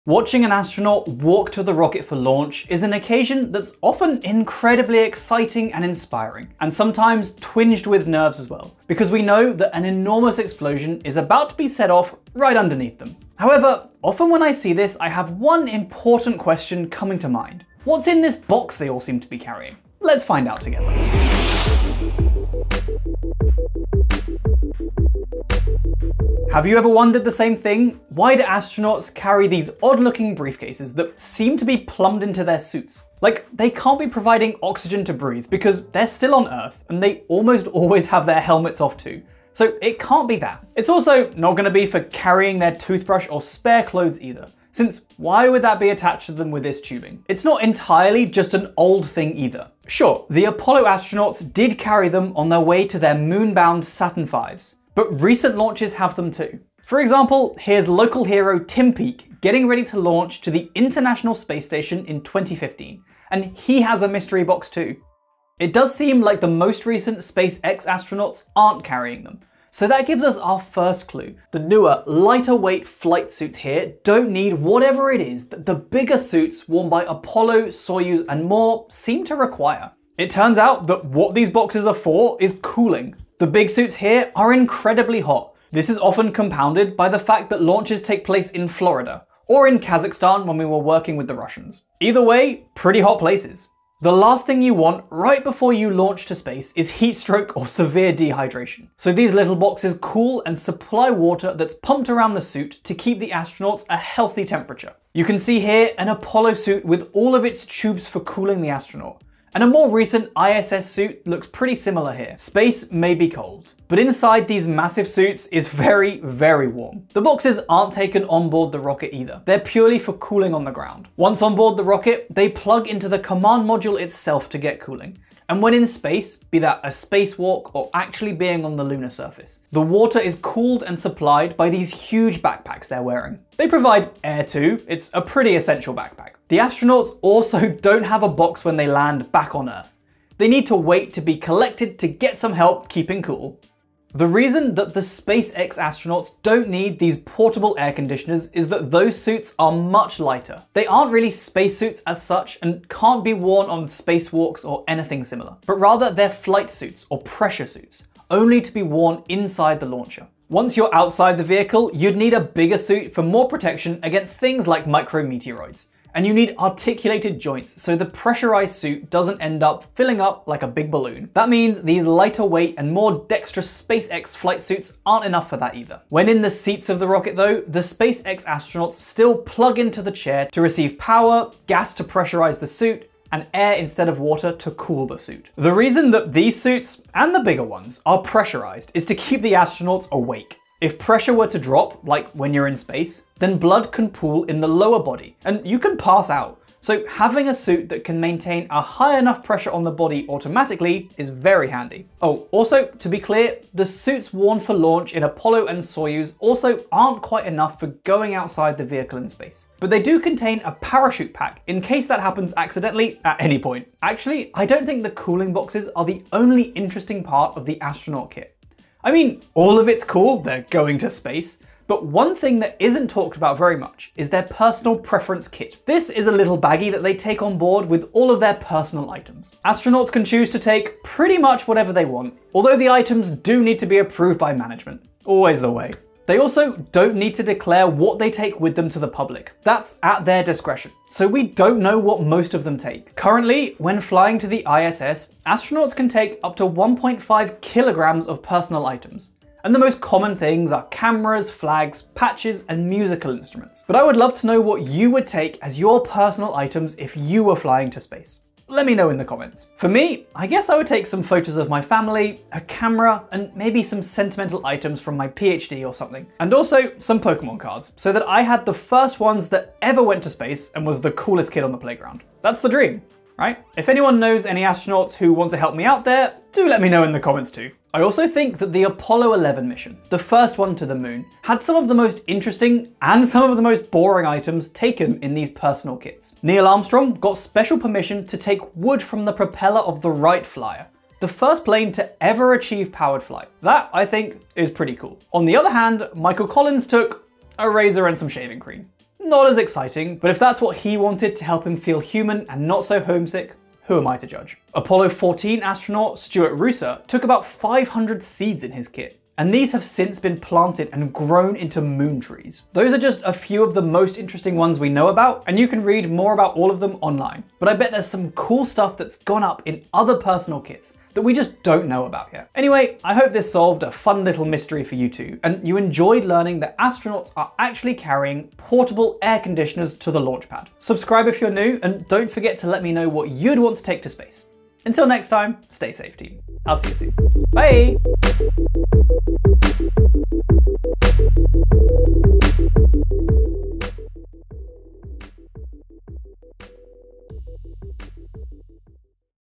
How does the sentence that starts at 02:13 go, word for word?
They provide air too, it's a pretty essential backpack.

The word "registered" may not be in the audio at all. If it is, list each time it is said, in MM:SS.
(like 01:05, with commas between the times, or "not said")
not said.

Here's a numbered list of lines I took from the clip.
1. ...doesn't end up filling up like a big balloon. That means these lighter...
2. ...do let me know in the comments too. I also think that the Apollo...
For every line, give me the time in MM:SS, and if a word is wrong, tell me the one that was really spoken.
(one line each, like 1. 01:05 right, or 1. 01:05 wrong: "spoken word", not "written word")
1. 02:49 right
2. 04:36 right.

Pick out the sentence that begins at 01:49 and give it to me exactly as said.
And a more recent ISS suit looks pretty similar here.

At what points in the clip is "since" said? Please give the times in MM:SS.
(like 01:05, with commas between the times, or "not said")
00:44, 05:09.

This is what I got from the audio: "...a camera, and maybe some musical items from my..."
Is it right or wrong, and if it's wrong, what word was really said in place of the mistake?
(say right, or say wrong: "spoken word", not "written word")
wrong: "sentimental", not "musical".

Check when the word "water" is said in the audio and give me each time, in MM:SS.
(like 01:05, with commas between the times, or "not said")
01:41, 02:09, 03:04.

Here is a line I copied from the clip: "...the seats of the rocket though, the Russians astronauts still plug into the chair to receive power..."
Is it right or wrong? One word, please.
wrong.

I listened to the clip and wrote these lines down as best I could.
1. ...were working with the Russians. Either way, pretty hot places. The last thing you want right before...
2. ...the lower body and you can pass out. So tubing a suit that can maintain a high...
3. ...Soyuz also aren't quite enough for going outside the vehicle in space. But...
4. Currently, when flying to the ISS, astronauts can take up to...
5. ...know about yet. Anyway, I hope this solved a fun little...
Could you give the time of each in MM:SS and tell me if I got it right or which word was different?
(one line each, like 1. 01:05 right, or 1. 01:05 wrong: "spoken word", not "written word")
1. 01:30 right
2. 03:14 wrong: "having", not "tubing"
3. 03:25 right
4. 04:03 right
5. 05:21 right.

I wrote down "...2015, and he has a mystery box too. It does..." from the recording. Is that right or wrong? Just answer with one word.
right.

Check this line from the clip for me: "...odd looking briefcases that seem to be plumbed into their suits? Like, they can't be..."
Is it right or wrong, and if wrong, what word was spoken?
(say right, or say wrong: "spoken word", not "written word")
right.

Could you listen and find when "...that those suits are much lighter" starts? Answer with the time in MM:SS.
02:28.